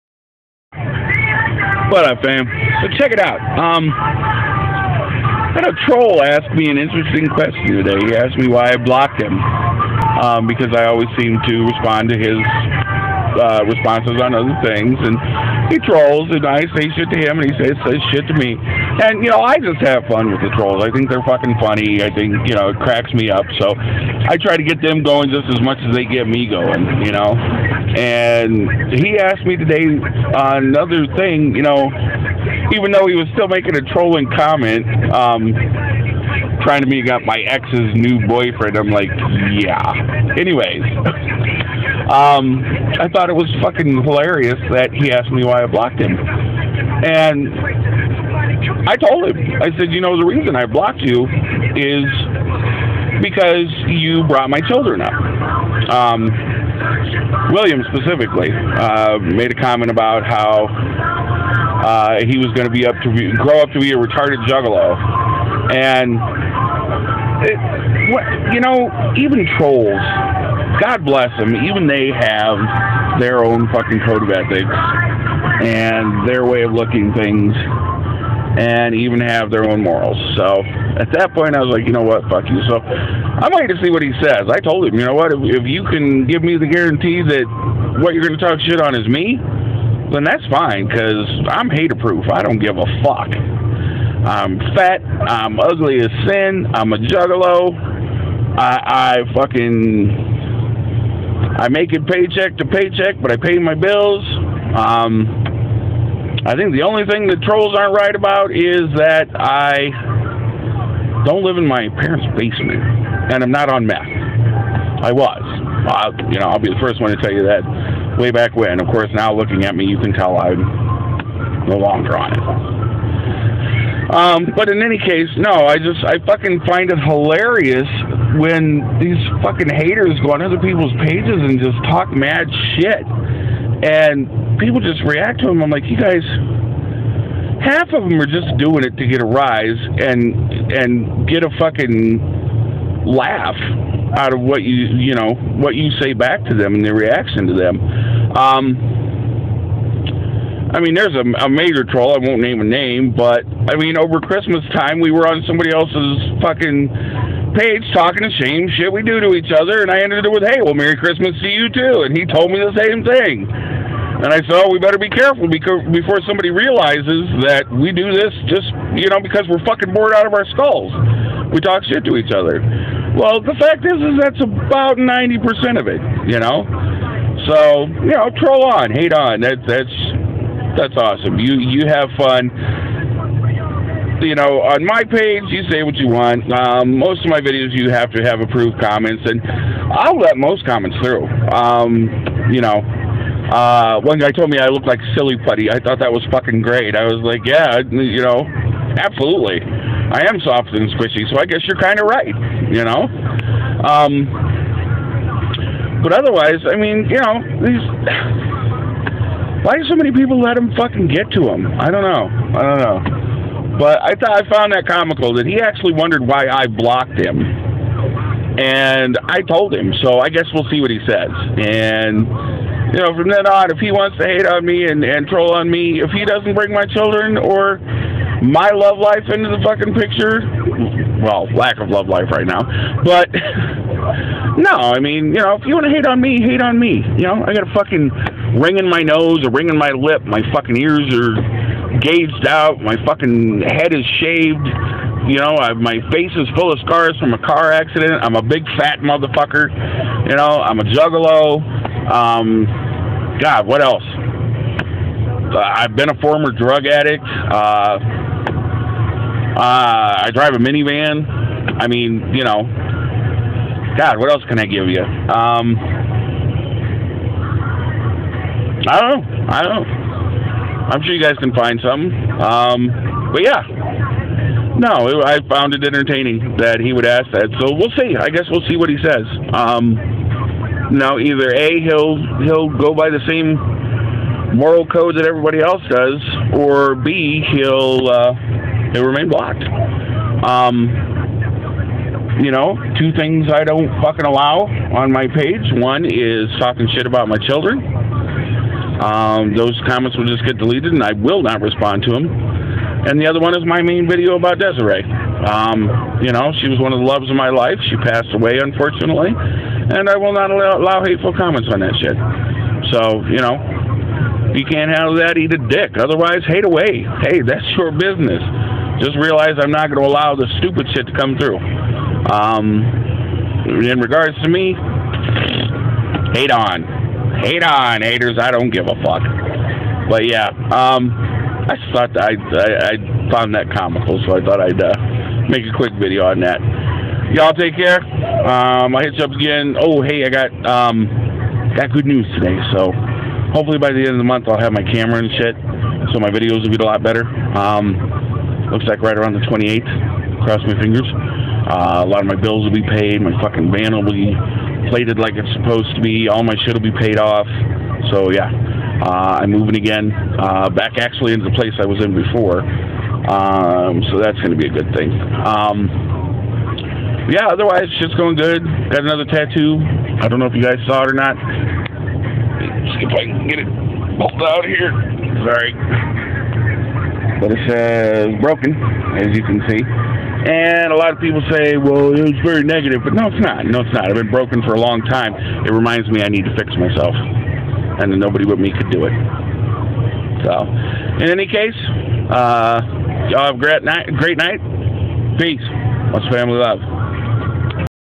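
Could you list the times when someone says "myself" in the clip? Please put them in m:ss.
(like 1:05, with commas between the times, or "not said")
6:26.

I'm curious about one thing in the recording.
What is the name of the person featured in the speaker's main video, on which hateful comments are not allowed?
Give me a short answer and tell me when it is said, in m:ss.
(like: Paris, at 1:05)
Desiree, at 5:04.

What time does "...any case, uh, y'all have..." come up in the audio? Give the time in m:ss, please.
6:31.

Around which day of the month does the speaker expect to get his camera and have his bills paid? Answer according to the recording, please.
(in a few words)
28th.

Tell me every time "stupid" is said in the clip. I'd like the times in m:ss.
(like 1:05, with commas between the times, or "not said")
5:20.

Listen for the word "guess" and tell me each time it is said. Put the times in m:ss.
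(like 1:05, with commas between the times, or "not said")
3:21, 3:40, 4:38.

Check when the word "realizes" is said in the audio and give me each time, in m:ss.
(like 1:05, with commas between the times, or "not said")
2:46, 5:19.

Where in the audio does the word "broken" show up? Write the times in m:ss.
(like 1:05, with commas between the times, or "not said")
6:18, 6:24.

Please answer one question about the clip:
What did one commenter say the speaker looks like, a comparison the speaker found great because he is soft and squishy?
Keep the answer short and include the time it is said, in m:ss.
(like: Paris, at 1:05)
Silly putty, at 3:15.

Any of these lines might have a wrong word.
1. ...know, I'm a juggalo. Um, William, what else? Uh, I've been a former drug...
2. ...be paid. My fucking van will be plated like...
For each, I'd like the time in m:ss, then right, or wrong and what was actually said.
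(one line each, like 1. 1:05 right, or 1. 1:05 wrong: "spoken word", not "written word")
1. 4:10 wrong: "God", not "William"
2. 5:52 right.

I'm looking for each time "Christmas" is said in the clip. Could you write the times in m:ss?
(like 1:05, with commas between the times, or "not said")
2:34, 2:40.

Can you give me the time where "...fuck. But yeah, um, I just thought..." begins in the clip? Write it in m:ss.
5:29.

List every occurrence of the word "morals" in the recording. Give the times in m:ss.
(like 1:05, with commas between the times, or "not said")
1:19, 4:44.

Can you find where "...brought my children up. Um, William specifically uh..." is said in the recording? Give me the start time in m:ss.
0:54.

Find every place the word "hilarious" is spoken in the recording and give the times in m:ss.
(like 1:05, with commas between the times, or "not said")
0:44, 2:06.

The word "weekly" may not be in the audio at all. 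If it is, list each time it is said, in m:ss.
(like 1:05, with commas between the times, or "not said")
not said.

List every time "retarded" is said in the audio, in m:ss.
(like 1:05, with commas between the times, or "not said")
1:03.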